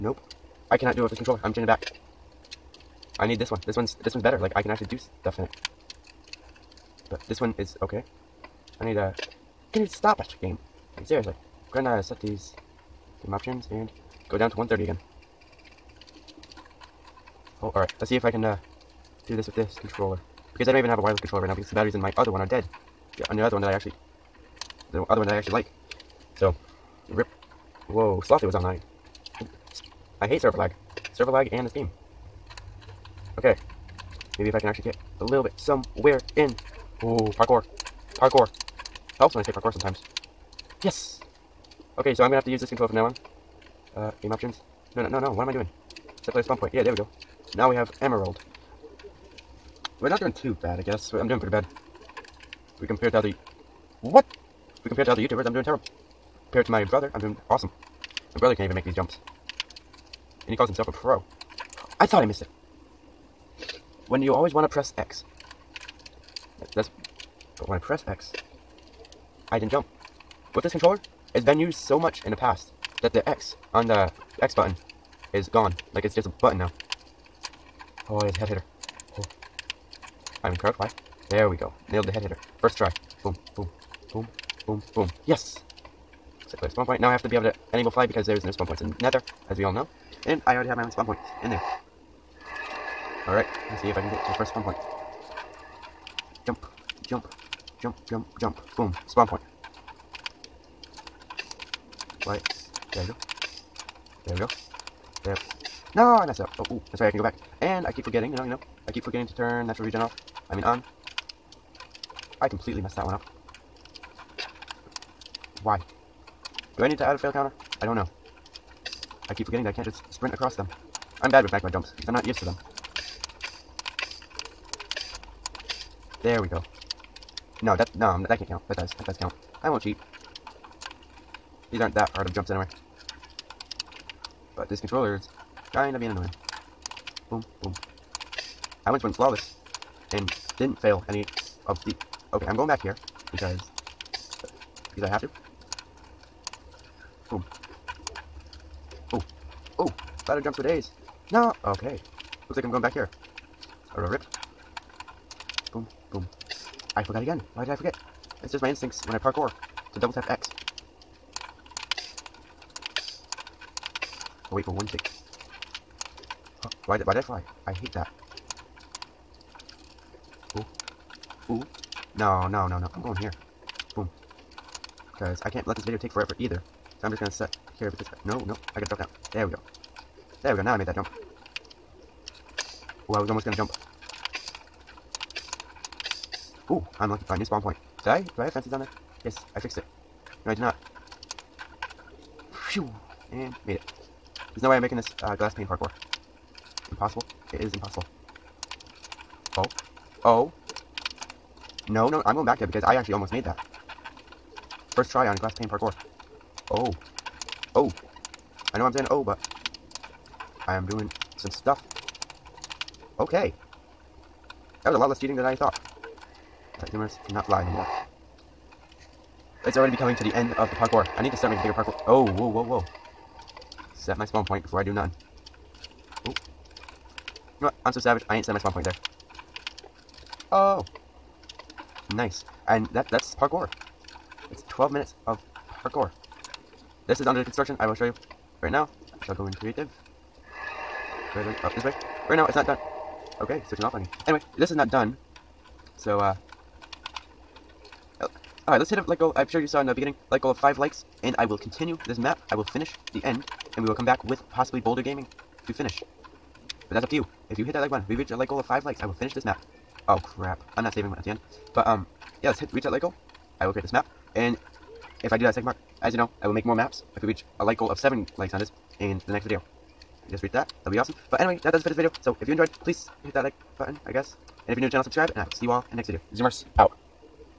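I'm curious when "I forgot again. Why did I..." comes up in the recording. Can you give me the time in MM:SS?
02:36.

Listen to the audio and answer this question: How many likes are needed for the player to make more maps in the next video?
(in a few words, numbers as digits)
7.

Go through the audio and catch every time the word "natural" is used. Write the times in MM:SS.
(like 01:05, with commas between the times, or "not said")
01:49.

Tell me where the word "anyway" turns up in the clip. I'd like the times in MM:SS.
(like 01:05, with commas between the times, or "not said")
02:12, 04:04, 04:31.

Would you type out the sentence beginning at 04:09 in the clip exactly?
I'm sure you saw in the beginning, like goal of 5 likes.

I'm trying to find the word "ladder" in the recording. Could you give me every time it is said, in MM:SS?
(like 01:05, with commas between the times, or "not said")
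02:30.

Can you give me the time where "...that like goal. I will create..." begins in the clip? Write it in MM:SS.
04:22.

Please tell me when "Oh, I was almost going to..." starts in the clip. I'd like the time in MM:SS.
03:03.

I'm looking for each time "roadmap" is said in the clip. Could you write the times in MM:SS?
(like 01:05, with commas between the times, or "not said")
not said.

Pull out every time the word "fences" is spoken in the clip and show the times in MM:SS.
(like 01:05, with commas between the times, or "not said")
03:08.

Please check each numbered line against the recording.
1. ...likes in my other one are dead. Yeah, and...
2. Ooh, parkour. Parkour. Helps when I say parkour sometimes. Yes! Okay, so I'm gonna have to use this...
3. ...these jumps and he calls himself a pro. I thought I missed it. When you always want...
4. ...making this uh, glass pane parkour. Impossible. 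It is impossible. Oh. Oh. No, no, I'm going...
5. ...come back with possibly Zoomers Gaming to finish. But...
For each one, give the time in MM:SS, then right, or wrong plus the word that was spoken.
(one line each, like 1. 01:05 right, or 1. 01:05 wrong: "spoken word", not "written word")
1. 00:21 wrong: "batteries", not "likes"
2. 00:37 right
3. 00:58 right
4. 03:14 right
5. 04:13 wrong: "Boulder", not "Zoomers".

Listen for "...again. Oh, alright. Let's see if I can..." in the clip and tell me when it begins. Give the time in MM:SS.
00:14.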